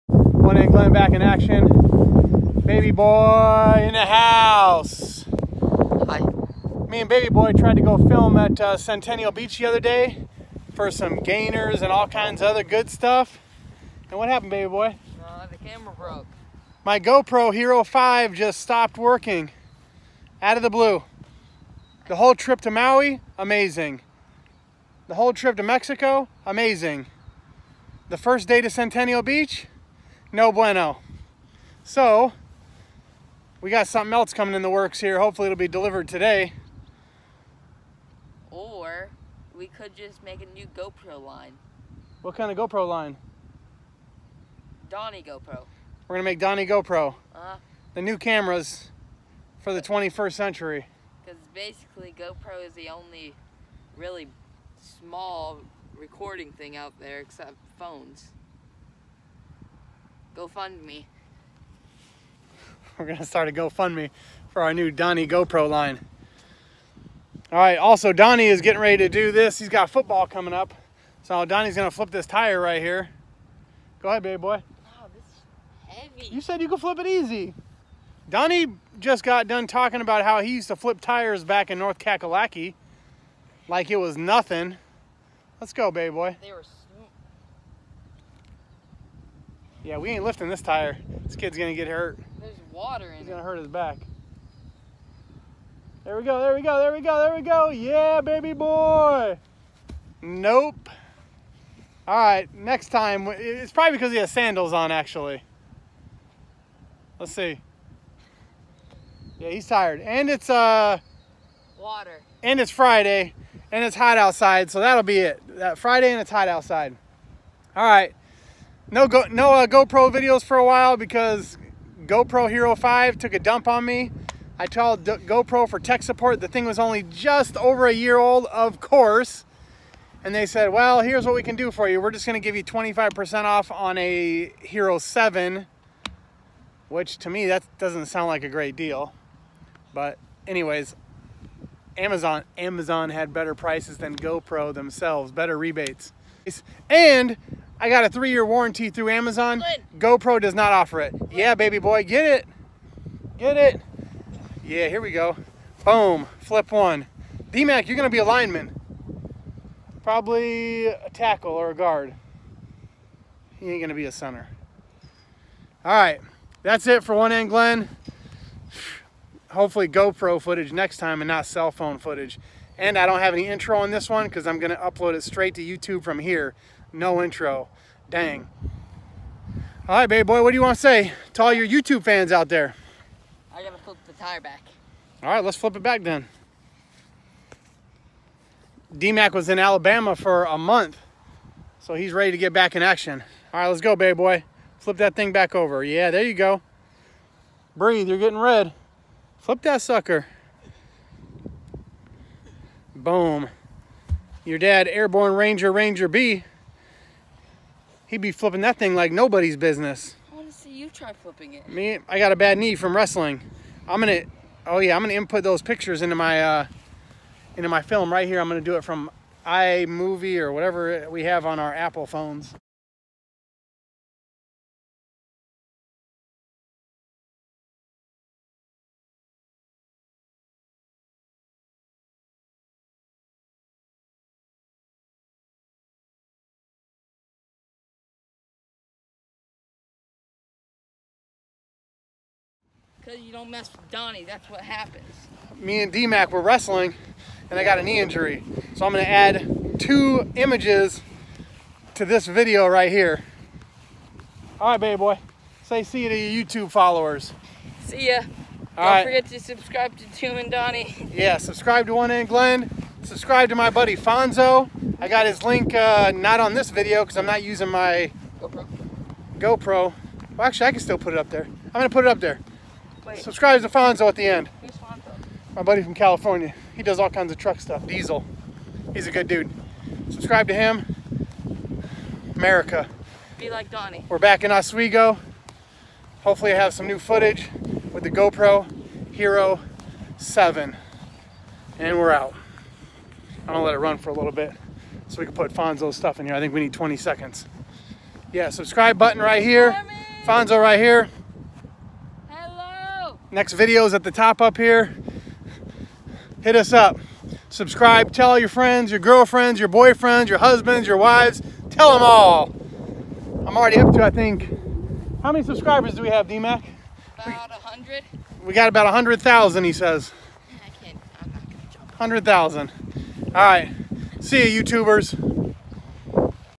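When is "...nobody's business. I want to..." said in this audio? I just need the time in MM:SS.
03:29.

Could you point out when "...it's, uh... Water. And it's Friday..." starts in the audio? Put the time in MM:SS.
01:50.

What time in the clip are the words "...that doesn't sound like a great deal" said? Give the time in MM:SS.
02:17.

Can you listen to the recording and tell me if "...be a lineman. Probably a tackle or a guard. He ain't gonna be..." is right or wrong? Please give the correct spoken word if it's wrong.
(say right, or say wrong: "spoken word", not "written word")
right.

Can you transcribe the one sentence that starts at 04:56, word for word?
I think we need 20 seconds.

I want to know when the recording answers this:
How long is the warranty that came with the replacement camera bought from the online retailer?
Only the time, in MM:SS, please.
02:28.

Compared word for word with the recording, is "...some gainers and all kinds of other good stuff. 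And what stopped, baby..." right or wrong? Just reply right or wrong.
wrong.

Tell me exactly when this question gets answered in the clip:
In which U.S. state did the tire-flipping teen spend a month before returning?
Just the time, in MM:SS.
03:09.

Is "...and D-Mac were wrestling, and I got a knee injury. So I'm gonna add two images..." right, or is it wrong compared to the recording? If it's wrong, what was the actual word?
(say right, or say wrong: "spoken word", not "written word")
right.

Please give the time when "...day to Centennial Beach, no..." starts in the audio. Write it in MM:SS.
00:28.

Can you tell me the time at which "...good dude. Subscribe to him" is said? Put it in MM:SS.
04:39.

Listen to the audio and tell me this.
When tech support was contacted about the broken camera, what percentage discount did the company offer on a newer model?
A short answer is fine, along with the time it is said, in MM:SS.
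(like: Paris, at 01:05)
25%, at 02:12.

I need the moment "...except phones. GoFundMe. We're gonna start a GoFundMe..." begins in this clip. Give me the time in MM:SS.
00:57.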